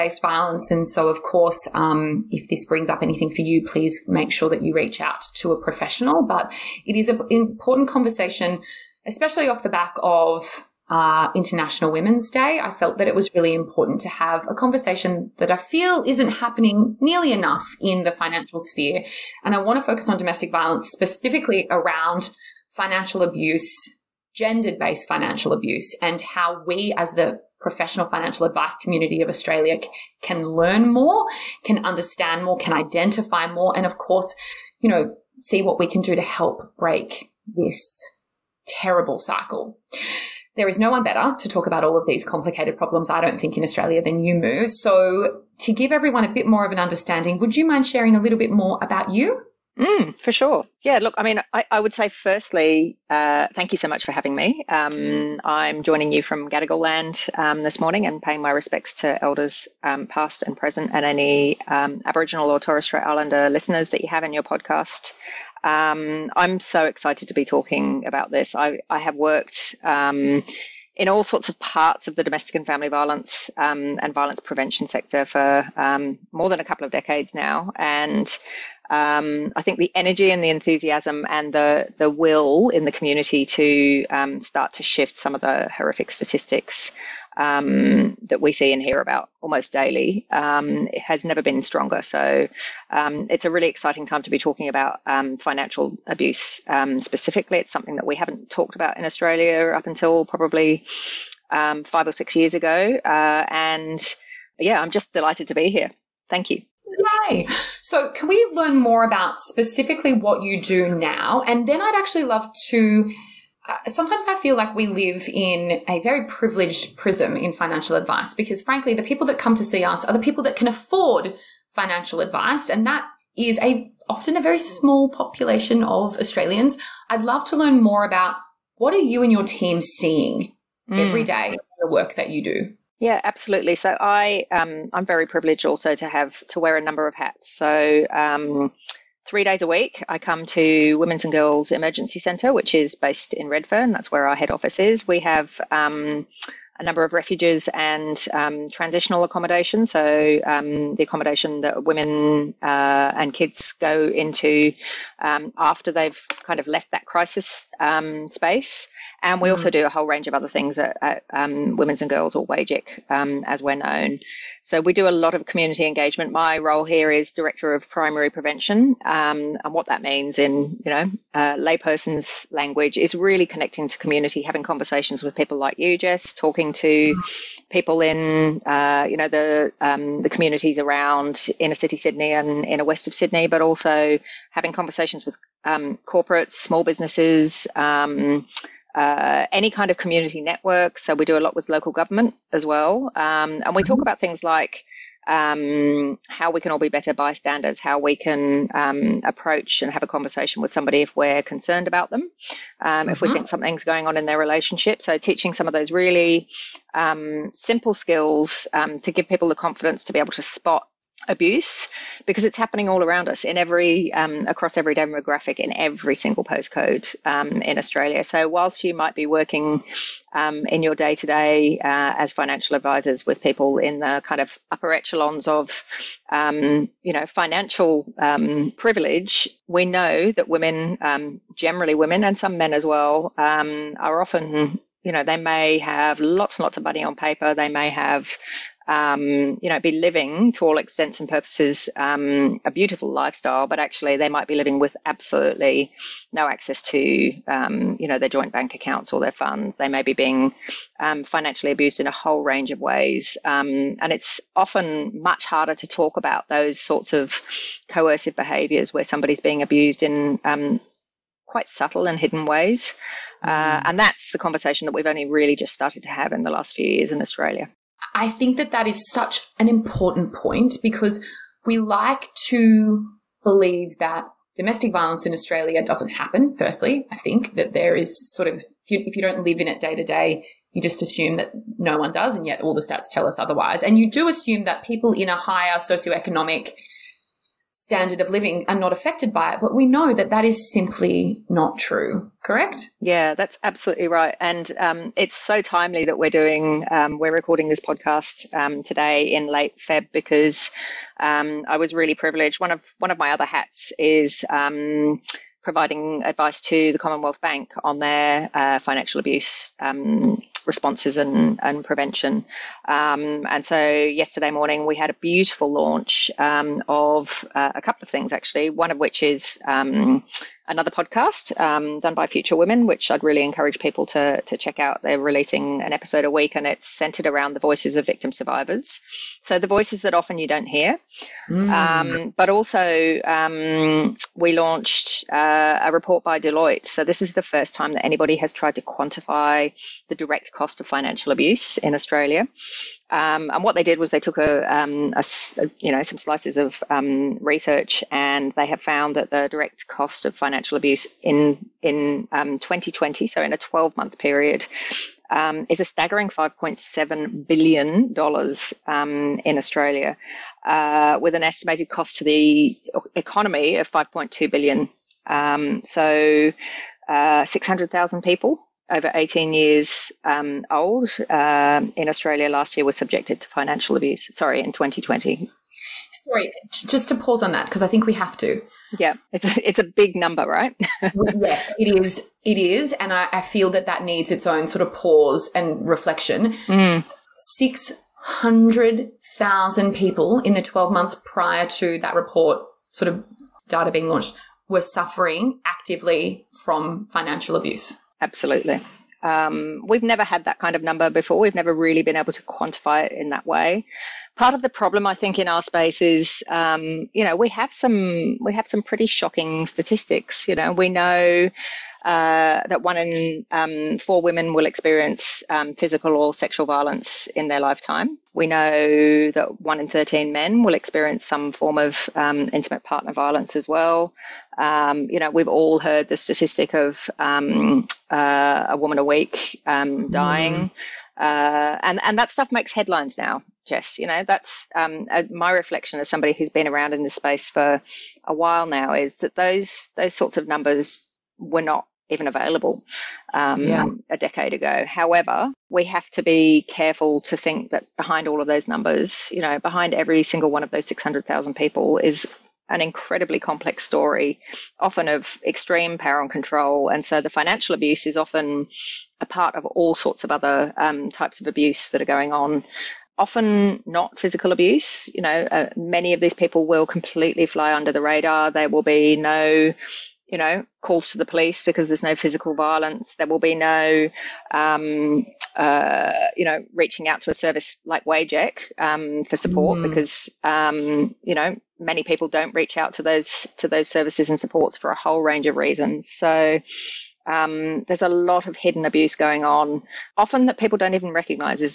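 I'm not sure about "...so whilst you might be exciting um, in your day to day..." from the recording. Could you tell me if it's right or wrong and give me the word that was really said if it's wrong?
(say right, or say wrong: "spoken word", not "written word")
wrong: "working", not "exciting".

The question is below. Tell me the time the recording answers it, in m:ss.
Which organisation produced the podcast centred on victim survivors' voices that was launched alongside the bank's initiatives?
5:22.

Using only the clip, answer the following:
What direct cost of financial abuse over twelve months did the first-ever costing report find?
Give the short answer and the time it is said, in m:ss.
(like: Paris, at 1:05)
$5.7 billion, at 5:56.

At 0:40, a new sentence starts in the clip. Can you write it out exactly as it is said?
There is no one better to talk about all of these complicated problems, I don't think, in Australia than you, Moo.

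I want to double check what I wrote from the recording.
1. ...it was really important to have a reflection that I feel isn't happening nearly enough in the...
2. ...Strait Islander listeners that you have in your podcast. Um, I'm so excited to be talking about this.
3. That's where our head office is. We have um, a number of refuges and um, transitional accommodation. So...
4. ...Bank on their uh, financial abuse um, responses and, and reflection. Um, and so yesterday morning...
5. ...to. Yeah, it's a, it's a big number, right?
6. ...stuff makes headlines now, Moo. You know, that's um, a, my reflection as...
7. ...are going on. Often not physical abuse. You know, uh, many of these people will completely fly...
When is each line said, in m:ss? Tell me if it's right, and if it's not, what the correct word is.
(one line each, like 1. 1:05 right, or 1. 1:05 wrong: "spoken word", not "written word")
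1. 0:13 wrong: "conversation", not "reflection"
2. 1:02 right
3. 2:23 right
4. 5:07 wrong: "prevention", not "reflection"
5. 6:18 right
6. 7:12 wrong: "Jess", not "Moo"
7. 7:42 right.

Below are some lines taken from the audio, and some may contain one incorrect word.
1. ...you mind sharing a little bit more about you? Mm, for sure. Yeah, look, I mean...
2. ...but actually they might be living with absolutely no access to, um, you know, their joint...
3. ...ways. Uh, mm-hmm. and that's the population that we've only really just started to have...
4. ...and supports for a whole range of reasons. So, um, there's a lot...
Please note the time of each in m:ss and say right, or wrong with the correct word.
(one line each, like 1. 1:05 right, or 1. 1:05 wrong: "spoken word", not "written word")
1. 0:47 right
2. 4:03 right
3. 4:22 wrong: "conversation", not "population"
4. 8:04 right.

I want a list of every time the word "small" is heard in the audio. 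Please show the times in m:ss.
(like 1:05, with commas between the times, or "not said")
2:04, 3:06.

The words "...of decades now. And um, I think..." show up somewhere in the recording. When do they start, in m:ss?
1:16.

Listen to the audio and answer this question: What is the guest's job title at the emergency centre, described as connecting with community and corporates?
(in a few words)
Director of Primary Prevention.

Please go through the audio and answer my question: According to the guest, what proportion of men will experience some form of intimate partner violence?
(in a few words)
1 in 13.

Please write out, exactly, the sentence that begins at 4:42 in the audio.
And yet all the stats tell us otherwise.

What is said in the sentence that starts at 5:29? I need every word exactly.
So, the voices that often you don't hear.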